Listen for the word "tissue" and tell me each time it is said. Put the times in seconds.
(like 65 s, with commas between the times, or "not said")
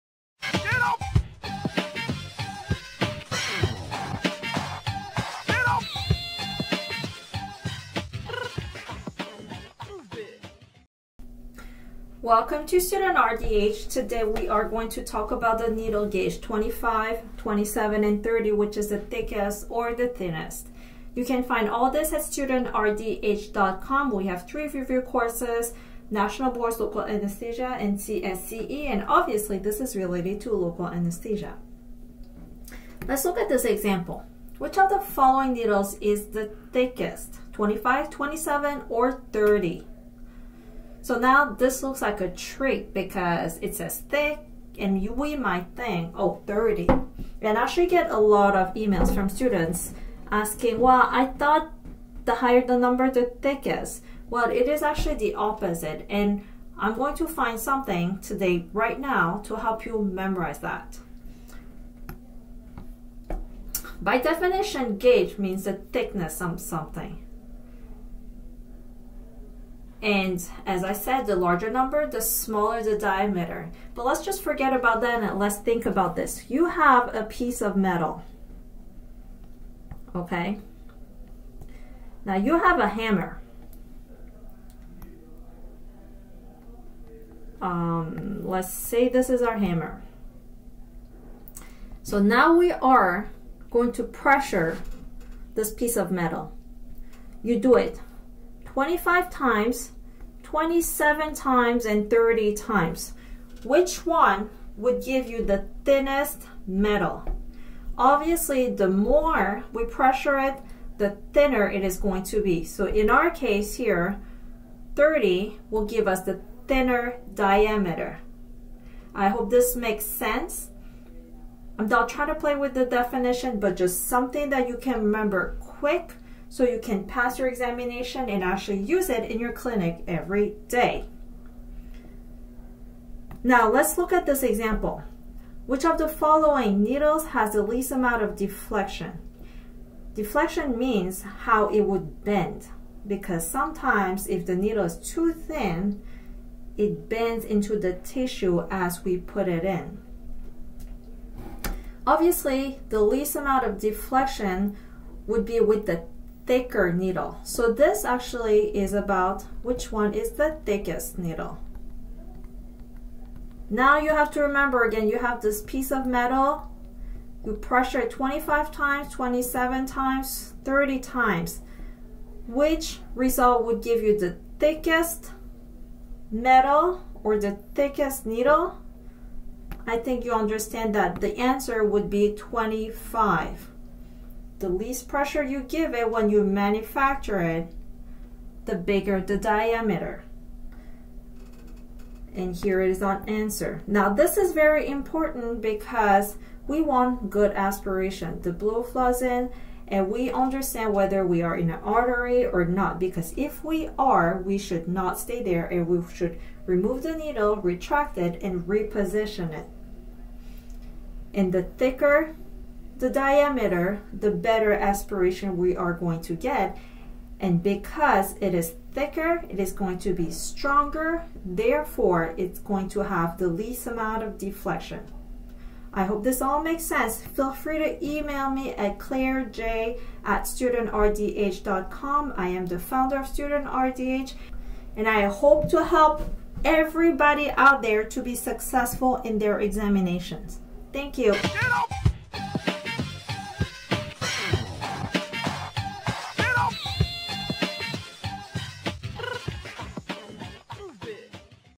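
147 s.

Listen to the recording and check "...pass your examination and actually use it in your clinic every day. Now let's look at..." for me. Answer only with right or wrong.
right.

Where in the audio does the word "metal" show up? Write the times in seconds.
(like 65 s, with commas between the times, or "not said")
77 s, 96 s, 106 s, 166 s, 176 s.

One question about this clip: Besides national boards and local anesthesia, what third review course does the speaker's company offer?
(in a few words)
CSCE.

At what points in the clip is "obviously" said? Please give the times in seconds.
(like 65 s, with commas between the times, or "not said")
29 s, 107 s, 152 s.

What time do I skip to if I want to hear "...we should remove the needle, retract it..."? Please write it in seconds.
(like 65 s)
205 s.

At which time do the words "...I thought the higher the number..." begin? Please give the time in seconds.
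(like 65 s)
51 s.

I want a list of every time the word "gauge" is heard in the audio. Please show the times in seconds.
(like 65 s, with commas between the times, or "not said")
16 s, 64 s.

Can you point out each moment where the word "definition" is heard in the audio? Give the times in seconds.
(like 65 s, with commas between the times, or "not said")
64 s, 122 s.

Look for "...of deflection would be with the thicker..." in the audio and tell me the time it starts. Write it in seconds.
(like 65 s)
153 s.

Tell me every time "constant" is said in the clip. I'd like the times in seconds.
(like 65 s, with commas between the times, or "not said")
not said.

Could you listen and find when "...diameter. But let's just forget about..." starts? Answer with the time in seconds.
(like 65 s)
72 s.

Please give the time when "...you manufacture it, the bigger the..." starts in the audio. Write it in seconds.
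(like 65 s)
186 s.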